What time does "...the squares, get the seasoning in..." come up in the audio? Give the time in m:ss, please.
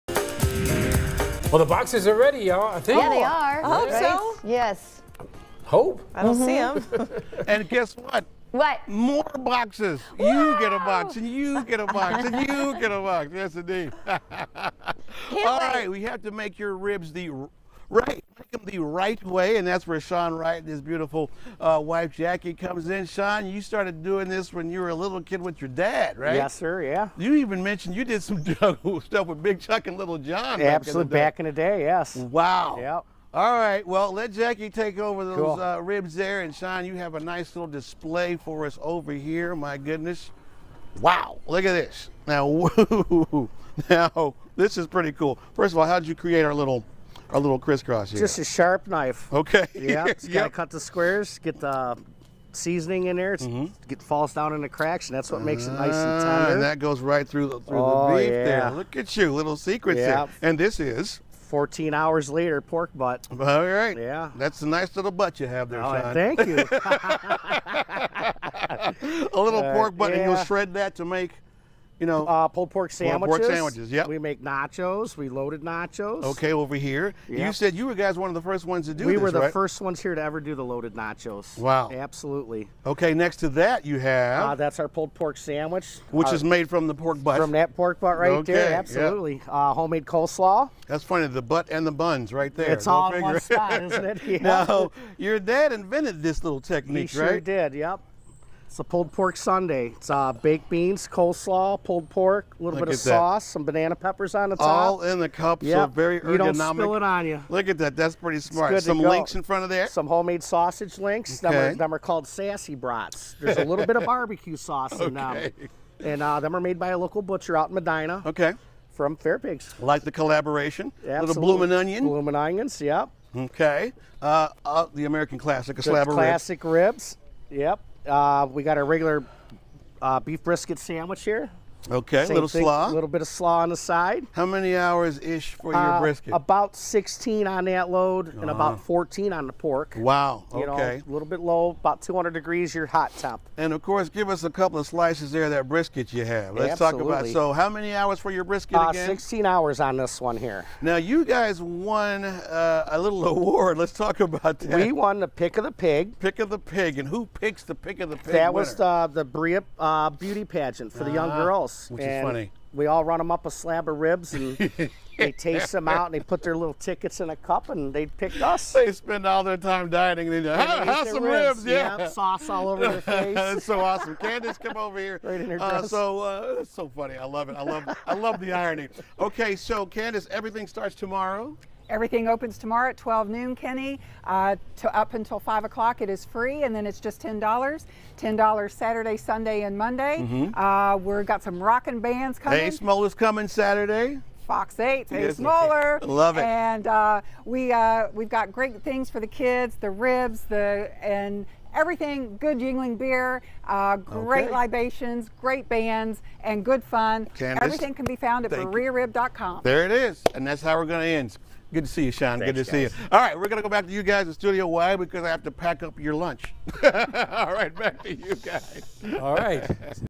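0:50.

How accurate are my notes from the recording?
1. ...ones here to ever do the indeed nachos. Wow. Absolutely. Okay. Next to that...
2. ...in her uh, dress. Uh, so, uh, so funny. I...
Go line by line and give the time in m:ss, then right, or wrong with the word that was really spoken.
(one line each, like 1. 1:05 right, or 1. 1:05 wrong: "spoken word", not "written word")
1. 1:19 wrong: "loaded", not "indeed"
2. 2:55 right.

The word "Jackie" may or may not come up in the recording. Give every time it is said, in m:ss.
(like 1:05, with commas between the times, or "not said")
0:22, 0:34.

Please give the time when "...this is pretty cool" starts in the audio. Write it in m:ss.
0:44.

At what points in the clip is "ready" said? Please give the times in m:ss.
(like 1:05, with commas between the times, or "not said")
0:02.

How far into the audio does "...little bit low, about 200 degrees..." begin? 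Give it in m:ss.
2:21.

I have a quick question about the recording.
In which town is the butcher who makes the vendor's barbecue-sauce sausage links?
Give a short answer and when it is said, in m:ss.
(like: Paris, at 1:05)
Medina, at 1:57.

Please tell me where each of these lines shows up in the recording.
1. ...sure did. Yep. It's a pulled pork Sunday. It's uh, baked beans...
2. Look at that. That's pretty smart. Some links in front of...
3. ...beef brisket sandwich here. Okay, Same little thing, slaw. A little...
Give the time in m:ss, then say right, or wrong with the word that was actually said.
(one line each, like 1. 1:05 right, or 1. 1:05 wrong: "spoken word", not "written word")
1. 1:37 right
2. 1:47 right
3. 2:10 right.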